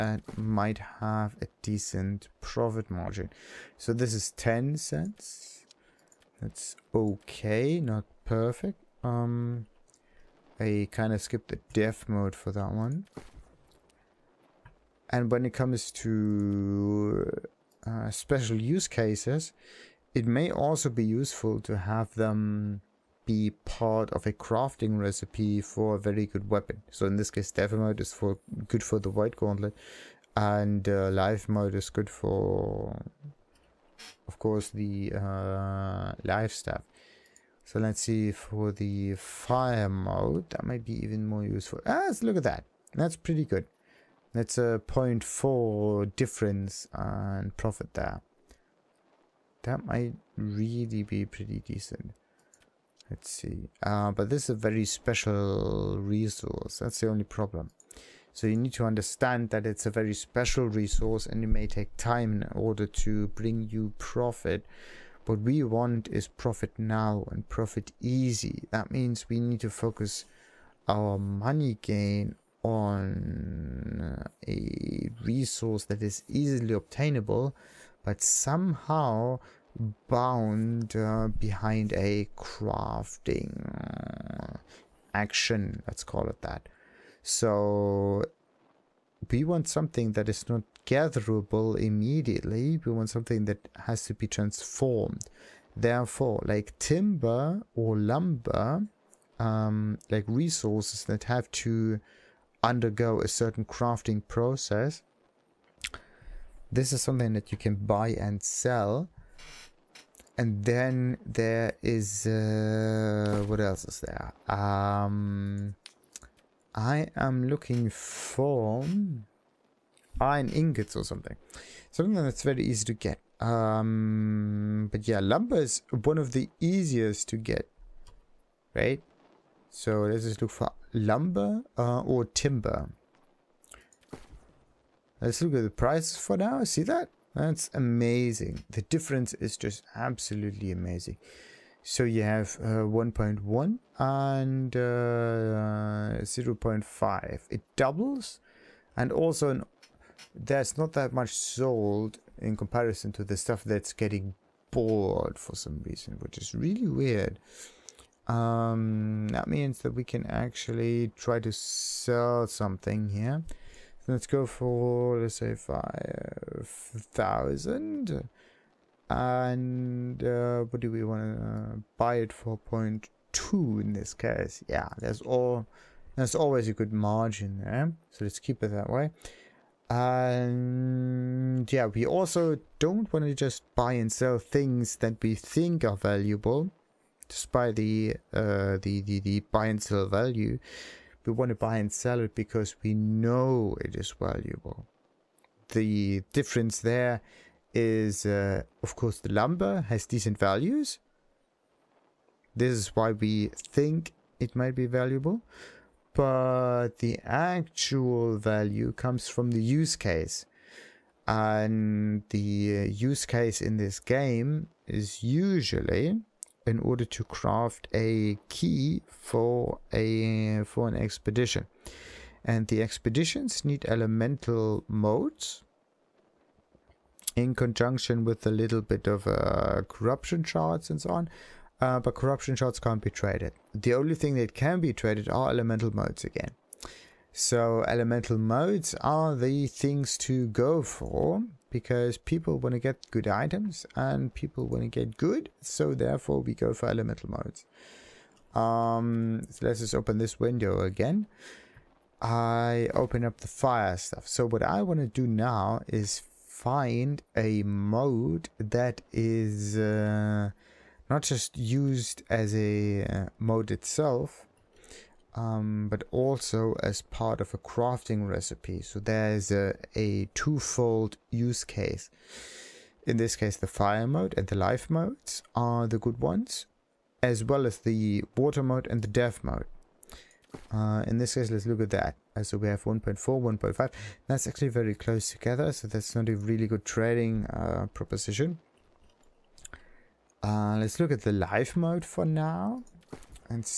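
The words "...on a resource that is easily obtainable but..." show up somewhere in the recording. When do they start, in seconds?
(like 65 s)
72 s.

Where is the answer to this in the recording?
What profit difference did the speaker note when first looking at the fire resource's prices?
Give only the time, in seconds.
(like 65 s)
44 s.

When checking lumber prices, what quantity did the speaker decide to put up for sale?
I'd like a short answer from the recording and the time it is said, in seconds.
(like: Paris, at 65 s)
5,000, at 165 s.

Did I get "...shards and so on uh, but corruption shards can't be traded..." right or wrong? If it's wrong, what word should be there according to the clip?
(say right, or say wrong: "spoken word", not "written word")
right.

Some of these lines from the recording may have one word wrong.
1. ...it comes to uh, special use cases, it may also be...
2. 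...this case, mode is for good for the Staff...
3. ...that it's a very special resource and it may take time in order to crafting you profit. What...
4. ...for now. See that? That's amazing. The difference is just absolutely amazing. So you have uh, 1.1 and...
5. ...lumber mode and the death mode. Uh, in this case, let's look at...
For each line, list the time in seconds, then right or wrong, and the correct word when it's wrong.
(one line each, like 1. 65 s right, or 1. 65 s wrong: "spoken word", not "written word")
1. 15 s right
2. 27 s wrong: "White", not "Staff"
3. 59 s wrong: "bring", not "crafting"
4. 136 s right
5. 278 s wrong: "water", not "lumber".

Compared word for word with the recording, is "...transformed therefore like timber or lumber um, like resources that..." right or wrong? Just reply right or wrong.
right.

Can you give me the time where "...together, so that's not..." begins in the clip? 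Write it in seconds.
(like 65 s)
285 s.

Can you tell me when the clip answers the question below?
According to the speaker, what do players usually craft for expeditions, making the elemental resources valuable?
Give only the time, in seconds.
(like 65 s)
217 s.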